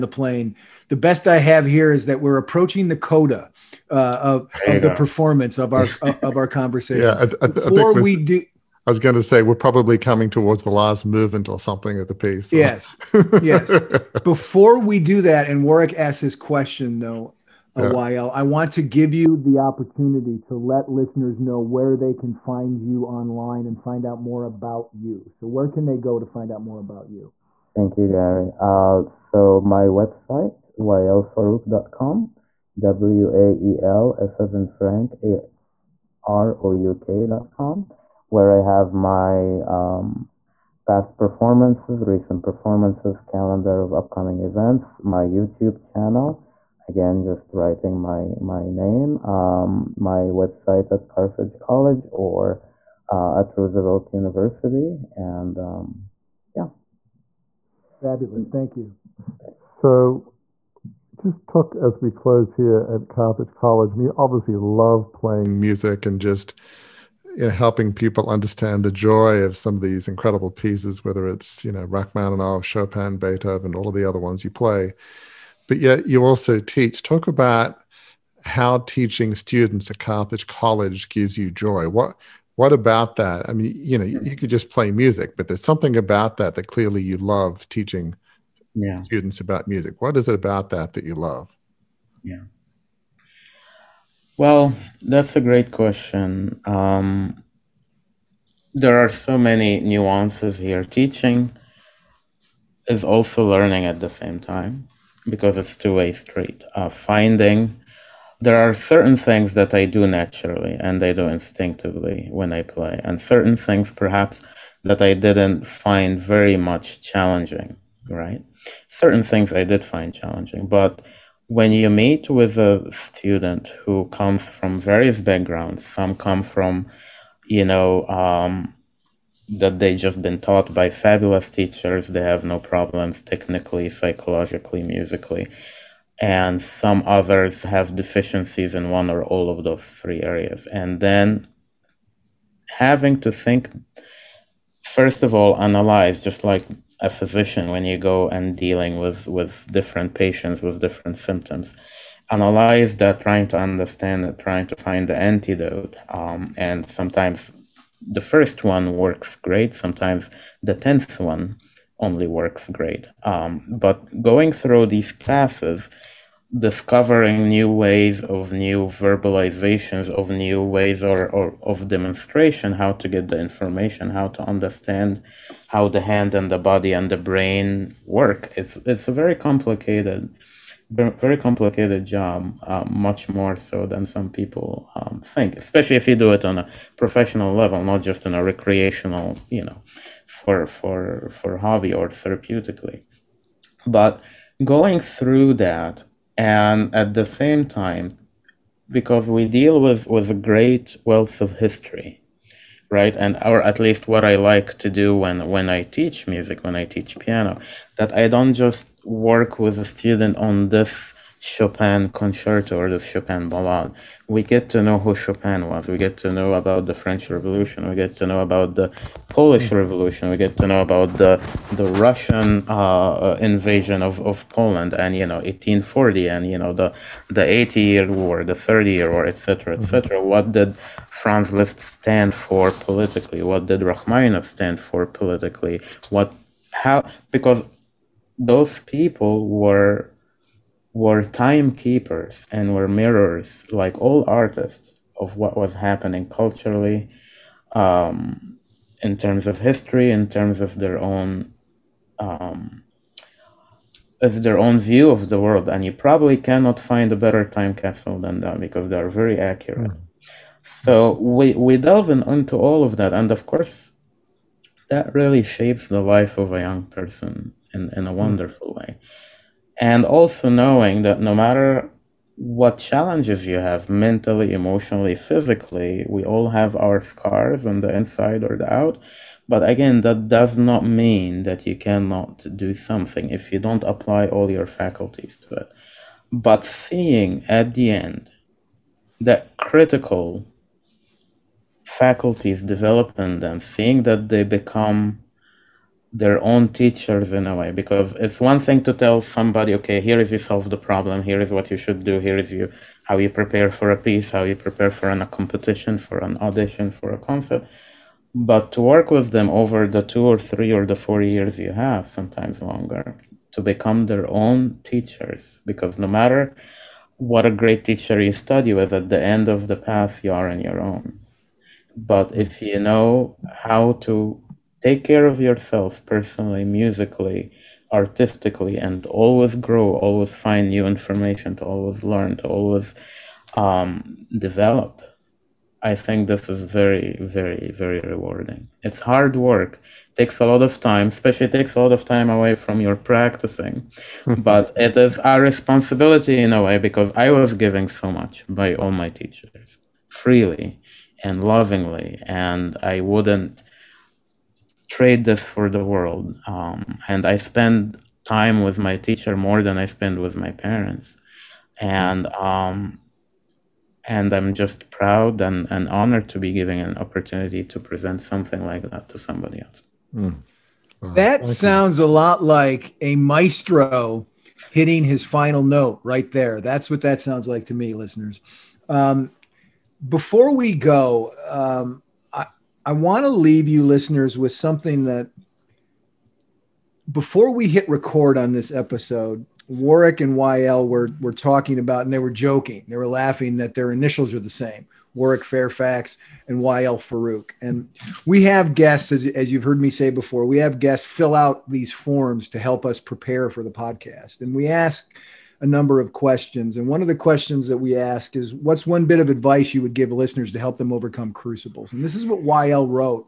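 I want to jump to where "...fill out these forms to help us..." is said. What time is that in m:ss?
6:41.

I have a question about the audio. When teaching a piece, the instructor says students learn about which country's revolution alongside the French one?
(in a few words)
Poland.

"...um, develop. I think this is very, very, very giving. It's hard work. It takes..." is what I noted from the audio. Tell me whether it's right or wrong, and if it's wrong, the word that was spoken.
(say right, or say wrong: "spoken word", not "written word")
wrong: "rewarding", not "giving".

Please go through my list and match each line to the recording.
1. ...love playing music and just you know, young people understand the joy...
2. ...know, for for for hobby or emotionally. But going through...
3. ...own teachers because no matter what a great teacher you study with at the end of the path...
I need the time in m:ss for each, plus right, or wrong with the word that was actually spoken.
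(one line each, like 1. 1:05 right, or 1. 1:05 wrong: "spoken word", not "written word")
1. 1:04 wrong: "helping", not "young"
2. 3:09 wrong: "therapeutically", not "emotionally"
3. 5:14 right.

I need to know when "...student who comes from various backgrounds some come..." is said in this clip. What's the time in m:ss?
2:02.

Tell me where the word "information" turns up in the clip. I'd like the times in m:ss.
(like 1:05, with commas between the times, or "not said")
2:53, 5:30.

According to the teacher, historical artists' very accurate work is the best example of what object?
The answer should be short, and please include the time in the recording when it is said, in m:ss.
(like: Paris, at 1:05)
Time capsule, at 4:17.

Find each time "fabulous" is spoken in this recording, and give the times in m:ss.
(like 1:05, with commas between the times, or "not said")
0:57, 2:10.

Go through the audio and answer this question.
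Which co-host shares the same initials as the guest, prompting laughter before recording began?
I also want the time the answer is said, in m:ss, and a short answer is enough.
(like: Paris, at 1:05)
Warwick Fairfax, at 6:35.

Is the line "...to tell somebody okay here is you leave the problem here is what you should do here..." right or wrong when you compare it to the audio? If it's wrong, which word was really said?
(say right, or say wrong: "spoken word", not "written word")
wrong: "solve", not "leave".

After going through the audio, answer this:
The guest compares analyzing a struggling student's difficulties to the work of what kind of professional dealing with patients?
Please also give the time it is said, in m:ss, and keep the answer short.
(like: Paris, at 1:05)
Physician, at 2:27.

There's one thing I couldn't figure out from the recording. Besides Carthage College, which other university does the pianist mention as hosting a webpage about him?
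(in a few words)
Roosevelt University.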